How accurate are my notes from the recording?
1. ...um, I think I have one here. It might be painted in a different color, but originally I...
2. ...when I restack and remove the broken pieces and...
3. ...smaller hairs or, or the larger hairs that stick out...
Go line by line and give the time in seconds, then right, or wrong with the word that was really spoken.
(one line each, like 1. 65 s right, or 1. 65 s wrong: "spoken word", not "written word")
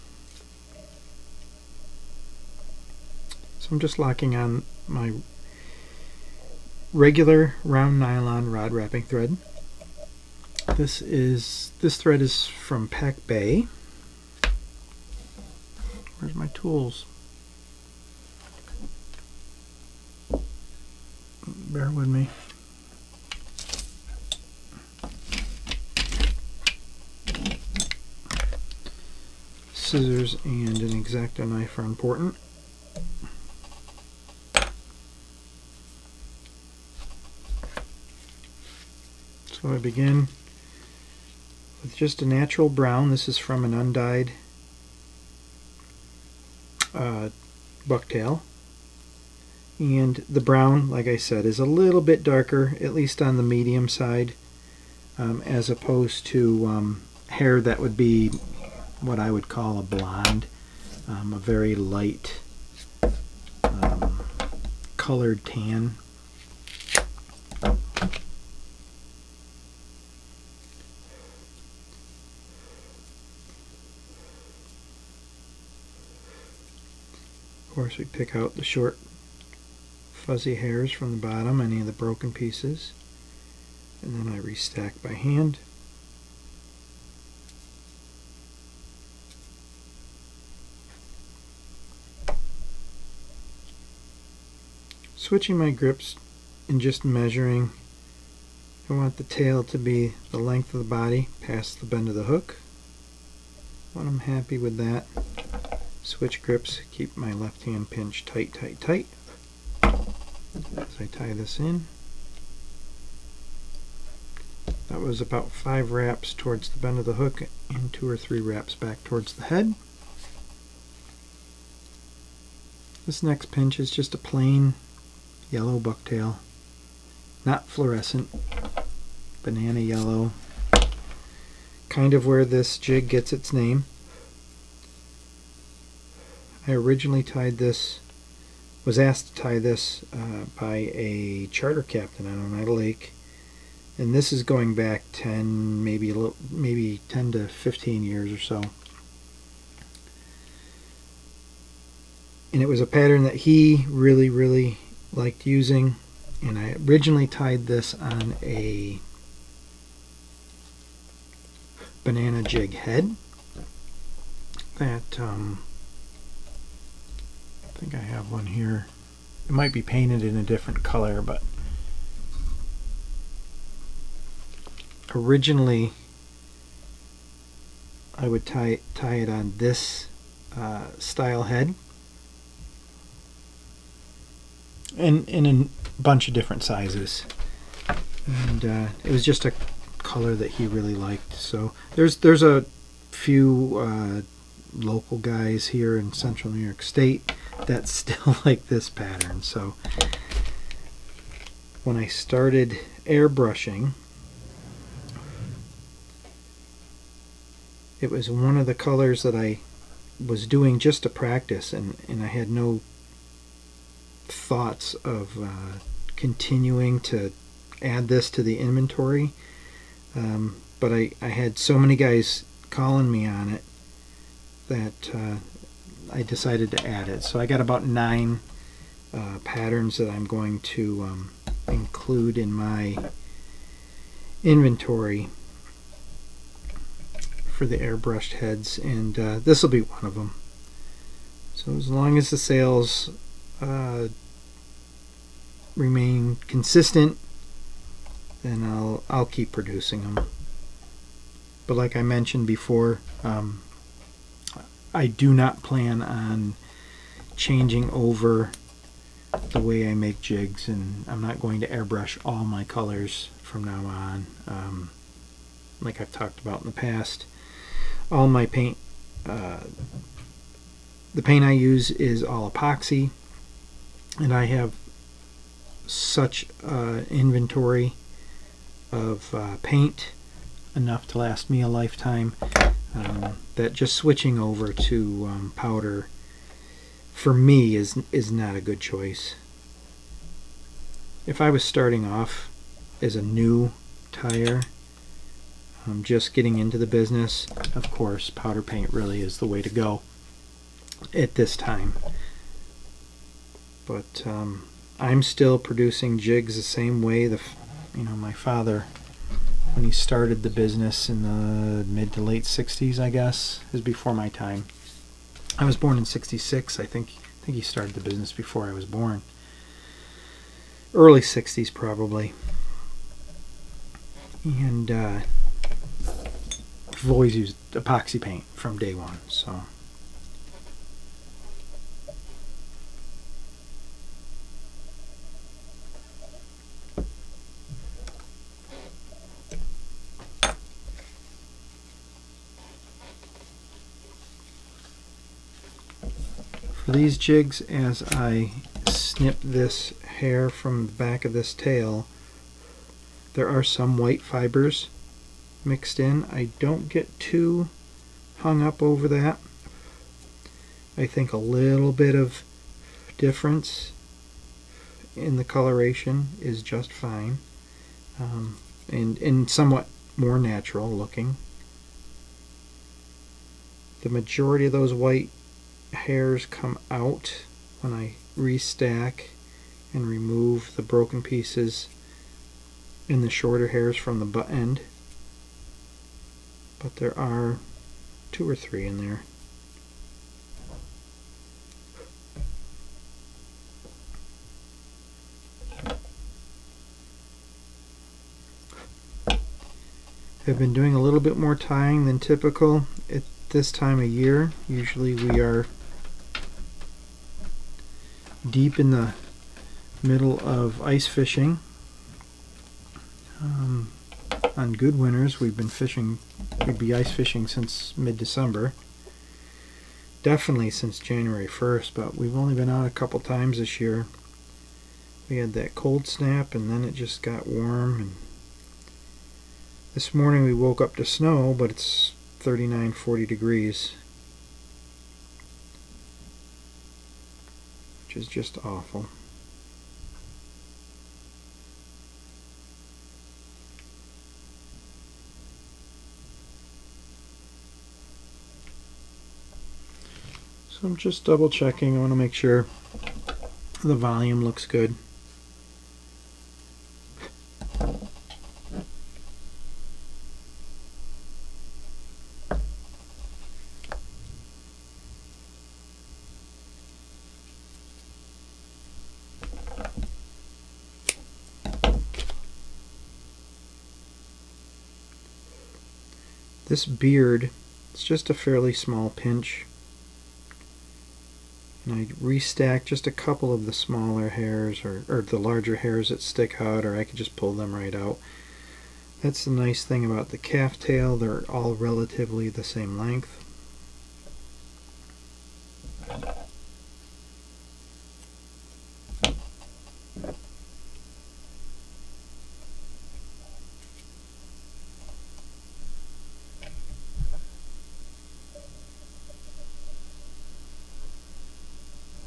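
1. 165 s right
2. 377 s right
3. 483 s right.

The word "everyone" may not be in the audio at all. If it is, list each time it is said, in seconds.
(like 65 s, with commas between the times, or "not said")
not said.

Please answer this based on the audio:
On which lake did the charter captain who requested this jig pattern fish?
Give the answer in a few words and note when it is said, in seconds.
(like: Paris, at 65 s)
Oneida Lake, at 142 s.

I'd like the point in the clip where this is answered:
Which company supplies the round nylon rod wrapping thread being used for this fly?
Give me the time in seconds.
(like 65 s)
12 s.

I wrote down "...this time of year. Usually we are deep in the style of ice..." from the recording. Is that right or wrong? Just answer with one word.
wrong.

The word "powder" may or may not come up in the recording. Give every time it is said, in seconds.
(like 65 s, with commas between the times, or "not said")
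285 s, 298 s.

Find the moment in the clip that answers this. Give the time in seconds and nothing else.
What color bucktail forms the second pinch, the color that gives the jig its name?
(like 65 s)
129 s.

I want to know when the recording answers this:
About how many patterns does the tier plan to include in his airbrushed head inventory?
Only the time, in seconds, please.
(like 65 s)
227 s.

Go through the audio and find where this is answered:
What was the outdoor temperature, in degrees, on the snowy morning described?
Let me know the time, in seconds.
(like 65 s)
432 s.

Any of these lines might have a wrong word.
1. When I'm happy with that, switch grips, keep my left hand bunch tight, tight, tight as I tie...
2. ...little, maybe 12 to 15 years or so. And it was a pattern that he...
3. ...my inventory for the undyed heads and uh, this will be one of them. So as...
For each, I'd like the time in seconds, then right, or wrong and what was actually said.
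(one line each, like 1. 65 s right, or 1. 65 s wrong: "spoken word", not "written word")
1. 103 s wrong: "pinch", not "bunch"
2. 146 s wrong: "10", not "12"
3. 232 s wrong: "airbrushed", not "undyed".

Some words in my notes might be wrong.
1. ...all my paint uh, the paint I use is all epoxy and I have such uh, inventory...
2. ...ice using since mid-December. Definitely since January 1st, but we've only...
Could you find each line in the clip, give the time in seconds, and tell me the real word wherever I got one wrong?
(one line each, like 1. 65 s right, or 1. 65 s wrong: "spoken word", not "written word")
1. 268 s right
2. 416 s wrong: "fishing", not "using".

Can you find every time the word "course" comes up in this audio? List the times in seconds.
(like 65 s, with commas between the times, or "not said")
77 s, 297 s.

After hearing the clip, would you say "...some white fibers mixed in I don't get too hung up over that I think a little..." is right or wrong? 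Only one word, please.
right.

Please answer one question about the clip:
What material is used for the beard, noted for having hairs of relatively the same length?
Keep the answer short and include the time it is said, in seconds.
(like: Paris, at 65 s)
calf tail, at 490 s.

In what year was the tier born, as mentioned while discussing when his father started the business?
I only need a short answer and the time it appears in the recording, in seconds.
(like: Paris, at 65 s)
1966, at 316 s.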